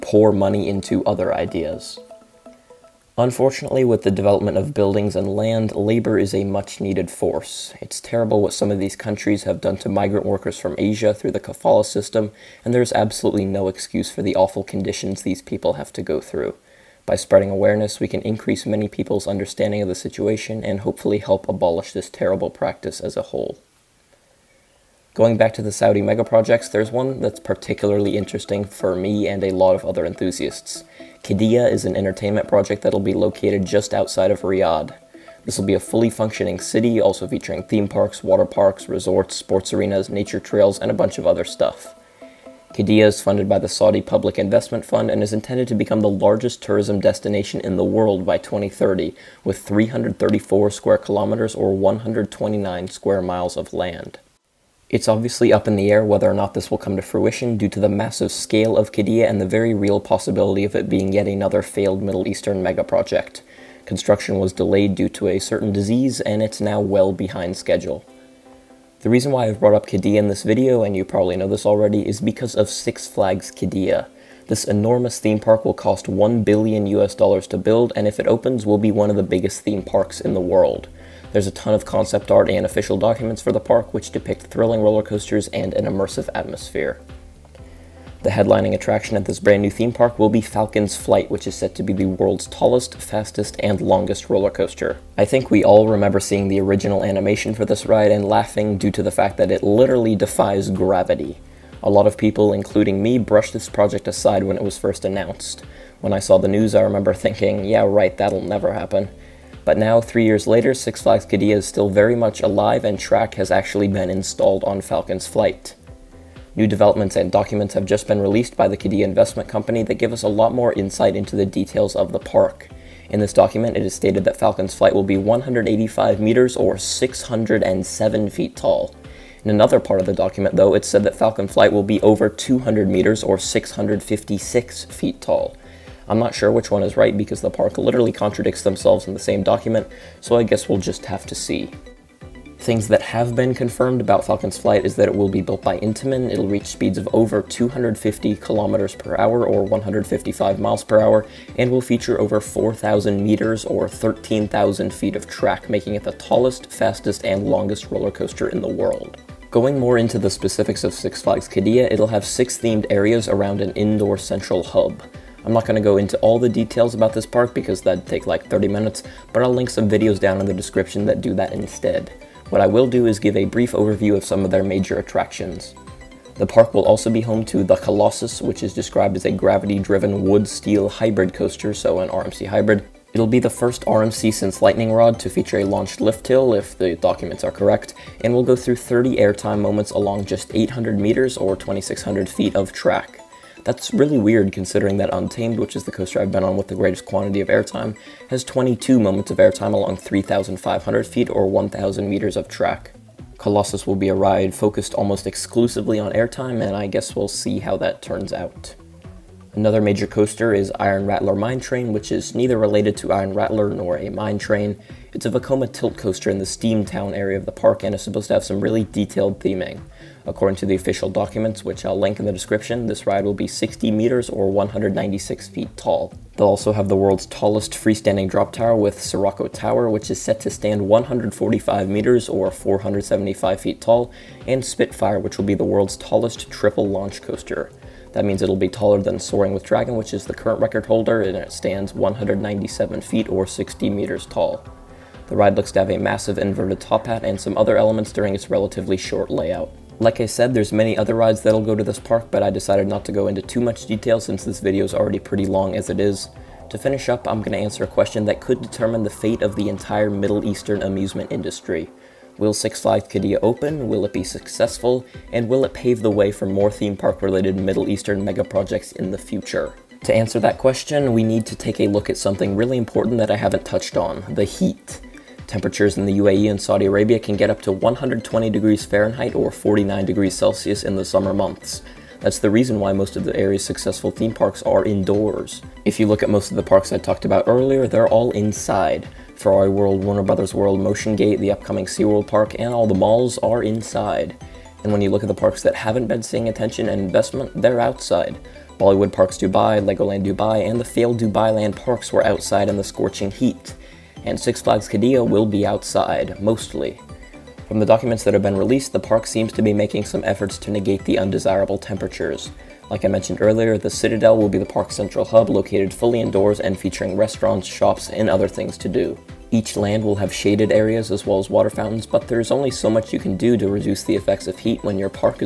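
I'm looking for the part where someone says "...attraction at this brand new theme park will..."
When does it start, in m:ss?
1:28.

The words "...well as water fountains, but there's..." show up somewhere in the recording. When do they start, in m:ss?
5:21.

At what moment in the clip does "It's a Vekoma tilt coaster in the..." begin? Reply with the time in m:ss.
3:35.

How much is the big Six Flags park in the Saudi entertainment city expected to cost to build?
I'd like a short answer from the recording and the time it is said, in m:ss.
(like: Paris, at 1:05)
1 billion US dollars, at 1:16.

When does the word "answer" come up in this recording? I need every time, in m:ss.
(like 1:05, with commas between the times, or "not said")
4:17, 4:30.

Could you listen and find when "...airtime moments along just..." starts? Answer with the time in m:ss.
3:09.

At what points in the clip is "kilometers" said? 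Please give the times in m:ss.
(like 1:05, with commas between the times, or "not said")
0:50, 2:28.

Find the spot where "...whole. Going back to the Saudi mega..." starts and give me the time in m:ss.
0:23.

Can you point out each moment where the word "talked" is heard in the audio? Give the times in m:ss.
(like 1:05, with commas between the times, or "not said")
4:46.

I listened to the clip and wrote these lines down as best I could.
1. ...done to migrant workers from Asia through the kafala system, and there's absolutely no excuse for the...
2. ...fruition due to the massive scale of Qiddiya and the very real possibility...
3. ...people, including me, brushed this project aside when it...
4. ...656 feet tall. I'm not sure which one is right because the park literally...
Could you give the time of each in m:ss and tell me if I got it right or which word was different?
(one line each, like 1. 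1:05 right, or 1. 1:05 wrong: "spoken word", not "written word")
1. 0:09 right
2. 0:57 right
3. 1:42 right
4. 2:13 right.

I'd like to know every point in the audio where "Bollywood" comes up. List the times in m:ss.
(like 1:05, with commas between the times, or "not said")
4:58.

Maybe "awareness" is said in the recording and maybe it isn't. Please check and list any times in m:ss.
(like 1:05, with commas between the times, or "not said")
0:17.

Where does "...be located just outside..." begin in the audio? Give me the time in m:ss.
0:32.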